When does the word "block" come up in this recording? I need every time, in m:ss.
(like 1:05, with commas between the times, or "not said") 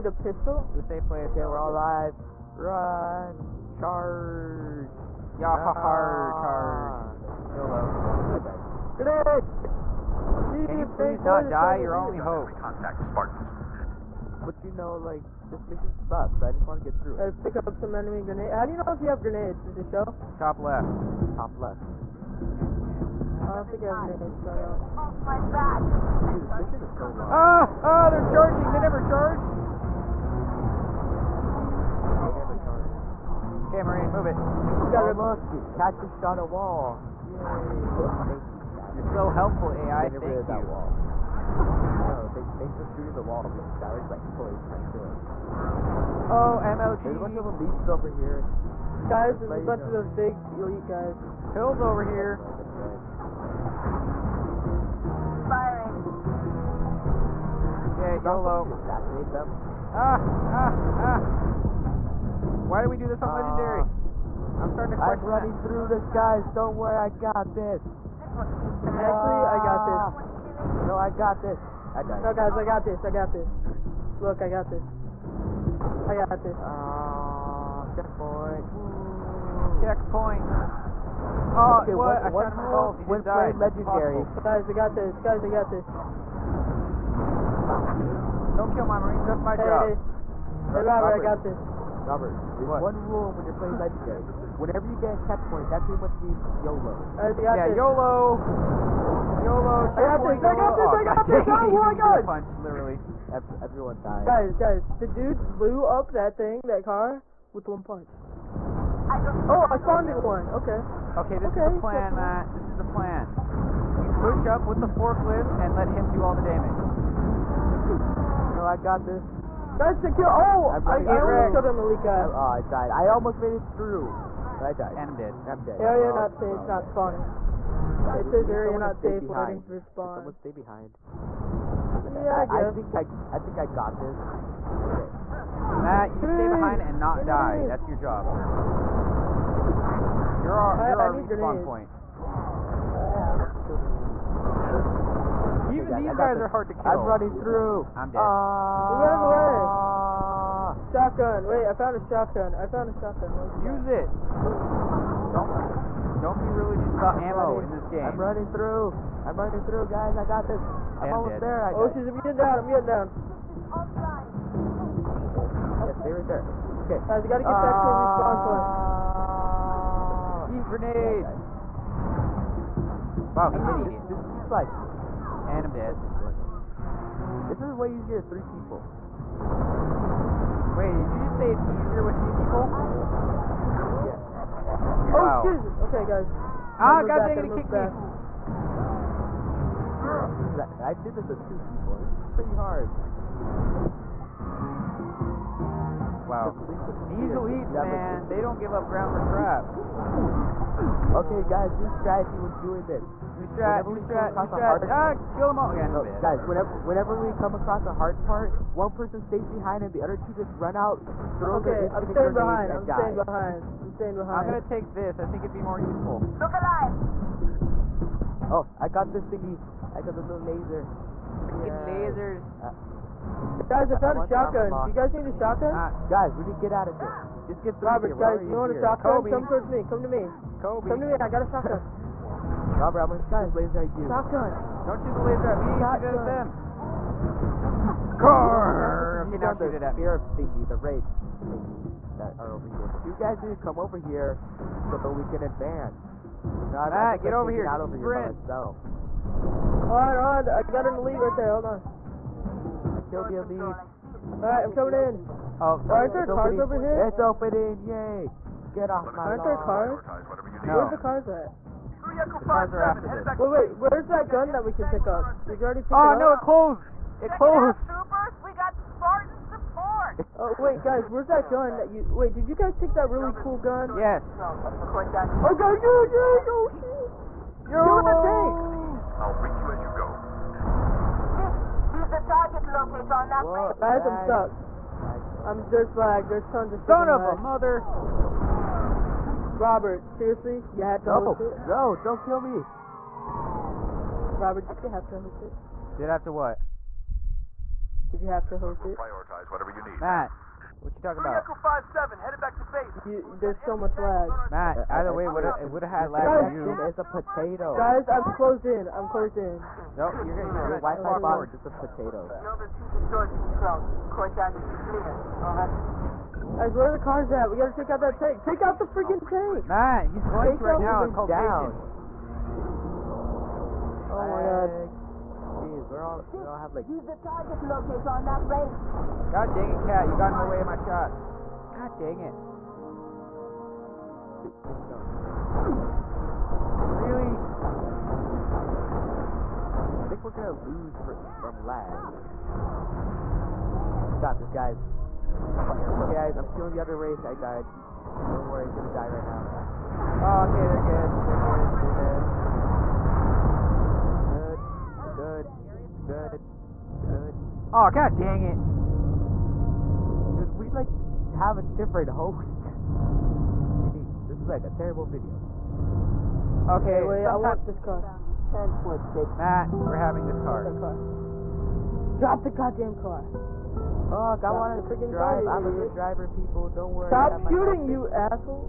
not said.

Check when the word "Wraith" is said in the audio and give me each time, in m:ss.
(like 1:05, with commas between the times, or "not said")
5:28, 5:46.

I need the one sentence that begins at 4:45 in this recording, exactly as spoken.
I'm, there's lag, there's tons of Son of a mother!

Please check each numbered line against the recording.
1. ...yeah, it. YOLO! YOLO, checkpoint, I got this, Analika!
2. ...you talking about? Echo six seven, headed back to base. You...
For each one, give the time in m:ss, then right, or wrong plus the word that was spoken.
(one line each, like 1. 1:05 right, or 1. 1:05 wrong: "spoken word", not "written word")
1. 1:37 wrong: "YOLO", not "Analika"
2. 5:00 wrong: "five", not "six".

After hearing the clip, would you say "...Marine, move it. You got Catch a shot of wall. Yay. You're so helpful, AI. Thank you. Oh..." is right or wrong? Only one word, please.
right.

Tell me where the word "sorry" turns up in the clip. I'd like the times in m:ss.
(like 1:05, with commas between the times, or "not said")
4:15.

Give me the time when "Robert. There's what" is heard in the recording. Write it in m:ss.
1:32.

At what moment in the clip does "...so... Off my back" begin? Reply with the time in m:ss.
0:24.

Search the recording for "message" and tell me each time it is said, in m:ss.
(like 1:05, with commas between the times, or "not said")
not said.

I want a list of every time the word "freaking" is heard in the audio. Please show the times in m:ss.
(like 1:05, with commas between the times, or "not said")
3:41, 5:18, 6:14.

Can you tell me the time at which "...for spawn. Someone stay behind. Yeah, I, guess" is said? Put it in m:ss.
2:09.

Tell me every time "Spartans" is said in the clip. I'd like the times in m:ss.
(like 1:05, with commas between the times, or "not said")
0:13, 4:28.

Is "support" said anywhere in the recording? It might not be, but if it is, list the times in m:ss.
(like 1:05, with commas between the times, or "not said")
4:29.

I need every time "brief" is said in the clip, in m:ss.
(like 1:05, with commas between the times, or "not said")
4:39.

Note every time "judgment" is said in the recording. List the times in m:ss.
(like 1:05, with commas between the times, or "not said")
not said.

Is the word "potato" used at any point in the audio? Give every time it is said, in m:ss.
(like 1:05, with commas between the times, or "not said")
5:07, 5:11.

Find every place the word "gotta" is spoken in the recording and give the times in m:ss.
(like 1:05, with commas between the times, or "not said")
2:47, 5:17.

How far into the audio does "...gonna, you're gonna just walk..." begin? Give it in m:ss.
5:10.